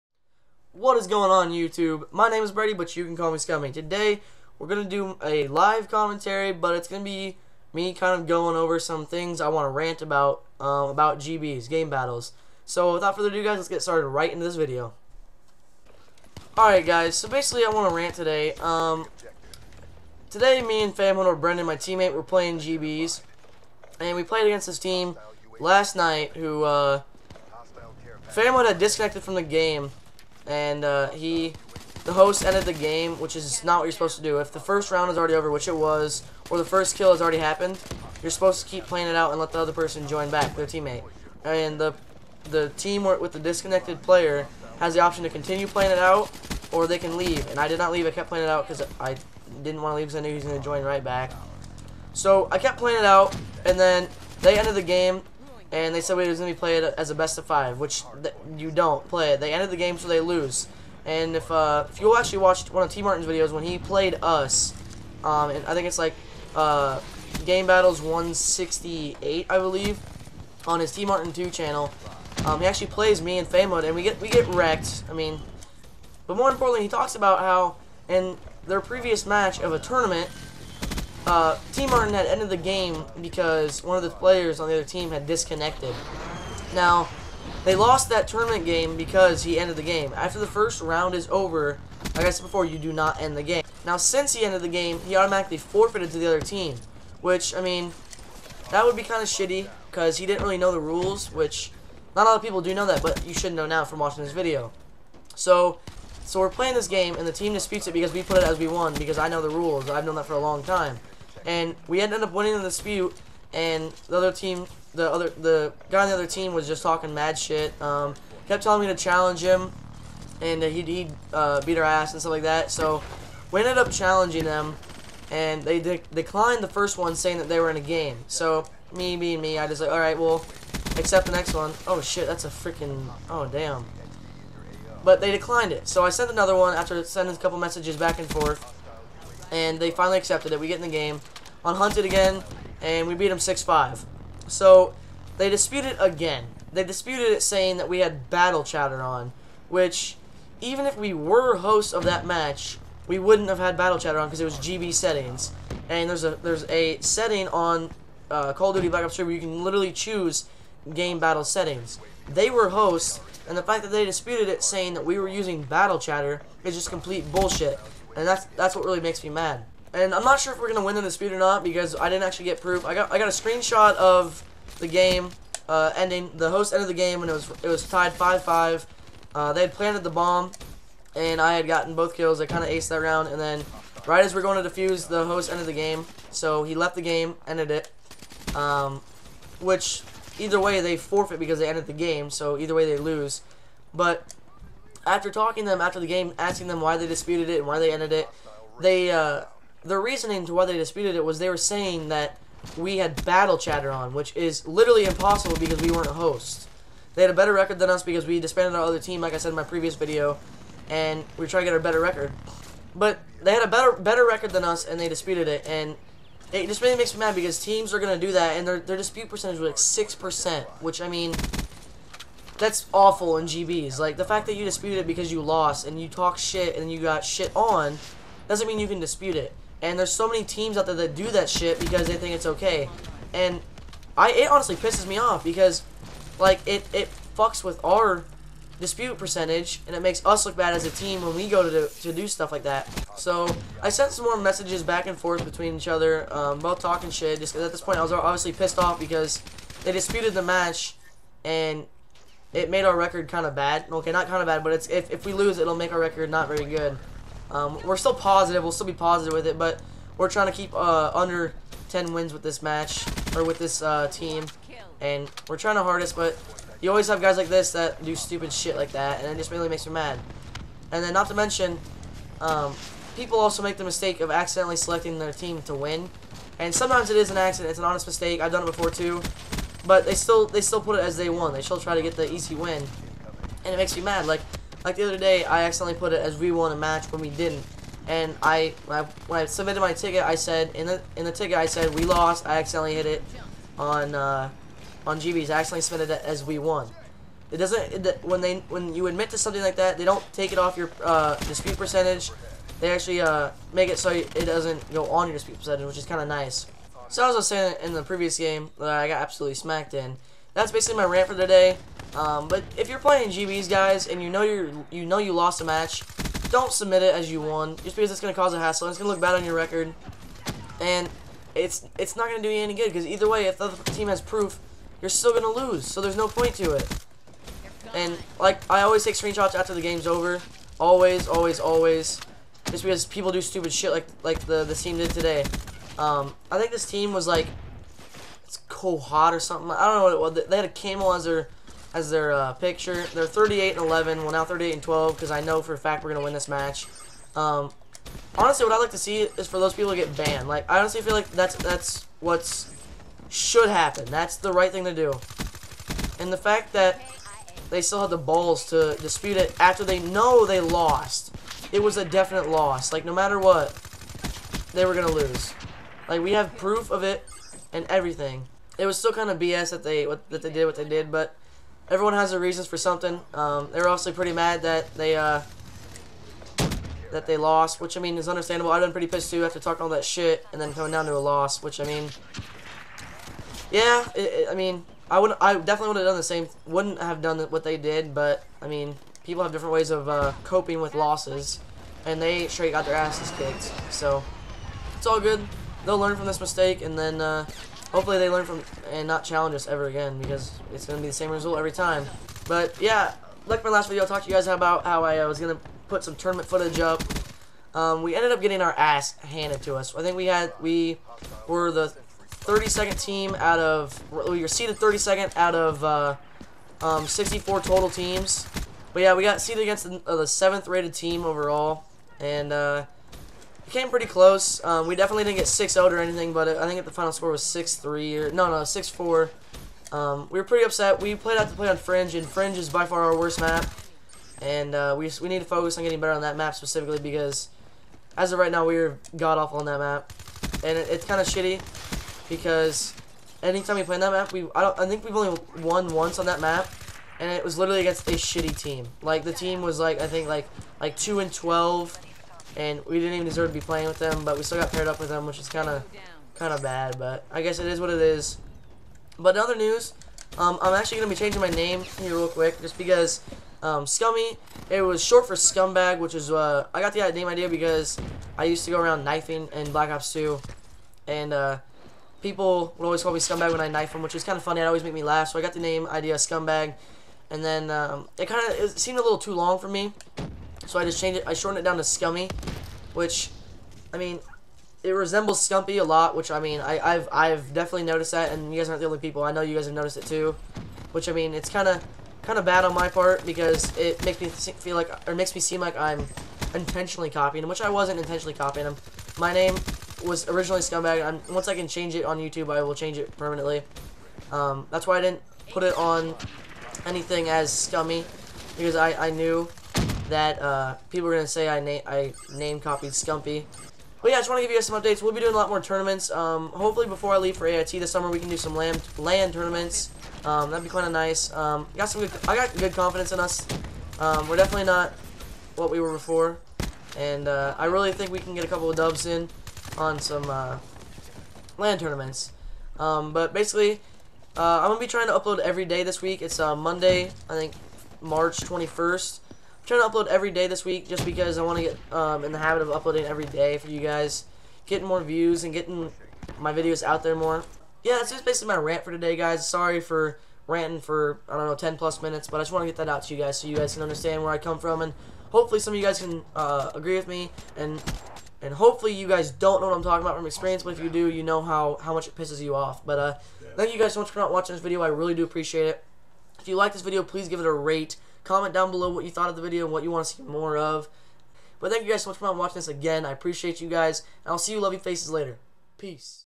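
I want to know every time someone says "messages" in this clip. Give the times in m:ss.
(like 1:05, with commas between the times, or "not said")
2:17, 4:04.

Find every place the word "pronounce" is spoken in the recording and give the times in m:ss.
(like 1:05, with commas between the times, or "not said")
not said.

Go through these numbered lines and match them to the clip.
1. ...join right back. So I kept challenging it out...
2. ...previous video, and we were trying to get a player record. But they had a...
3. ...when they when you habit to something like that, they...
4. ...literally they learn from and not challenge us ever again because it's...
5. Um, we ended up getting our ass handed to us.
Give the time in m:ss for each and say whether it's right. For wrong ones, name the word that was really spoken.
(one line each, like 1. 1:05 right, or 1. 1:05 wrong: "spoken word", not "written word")
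1. 0:50 wrong: "playing", not "challenging"
2. 3:29 wrong: "better", not "player"
3. 4:58 wrong: "admit", not "habit"
4. 6:37 wrong: "hopefully", not "literally"
5. 6:47 right.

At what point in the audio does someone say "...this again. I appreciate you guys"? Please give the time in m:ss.
9:32.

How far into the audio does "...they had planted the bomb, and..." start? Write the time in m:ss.
2:59.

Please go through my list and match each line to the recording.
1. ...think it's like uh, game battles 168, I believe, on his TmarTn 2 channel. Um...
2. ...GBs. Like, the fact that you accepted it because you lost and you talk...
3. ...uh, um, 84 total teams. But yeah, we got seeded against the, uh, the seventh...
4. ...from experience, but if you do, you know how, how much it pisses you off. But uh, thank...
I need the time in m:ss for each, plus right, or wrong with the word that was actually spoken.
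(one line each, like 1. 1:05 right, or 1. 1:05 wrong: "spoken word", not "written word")
1. 1:05 right
2. 3:43 wrong: "disputed", not "accepted"
3. 6:55 wrong: "64", not "84"
4. 9:20 right.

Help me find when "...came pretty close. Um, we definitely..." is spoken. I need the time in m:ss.
7:03.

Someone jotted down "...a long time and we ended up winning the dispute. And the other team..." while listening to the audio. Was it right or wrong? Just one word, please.
right.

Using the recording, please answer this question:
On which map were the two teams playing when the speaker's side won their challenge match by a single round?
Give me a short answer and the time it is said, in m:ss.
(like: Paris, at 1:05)
Hunted, at 2:21.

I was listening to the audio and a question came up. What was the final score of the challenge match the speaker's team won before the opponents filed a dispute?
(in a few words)
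6-5.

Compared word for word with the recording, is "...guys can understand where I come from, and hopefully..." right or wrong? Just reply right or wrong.
right.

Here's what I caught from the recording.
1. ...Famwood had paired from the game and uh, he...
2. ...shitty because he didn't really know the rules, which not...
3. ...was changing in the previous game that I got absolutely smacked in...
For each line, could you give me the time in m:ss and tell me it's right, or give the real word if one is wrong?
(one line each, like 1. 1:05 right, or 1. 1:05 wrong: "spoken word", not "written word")
1. 0:28 wrong: "disconnected", not "paired"
2. 1:39 right
3. 5:07 wrong: "saying", not "changing".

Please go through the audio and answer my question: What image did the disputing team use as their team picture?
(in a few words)
a camel.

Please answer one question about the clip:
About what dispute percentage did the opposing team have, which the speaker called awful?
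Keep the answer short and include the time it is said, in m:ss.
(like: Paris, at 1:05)
6%, at 3:40.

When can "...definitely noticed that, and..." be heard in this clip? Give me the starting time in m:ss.
8:07.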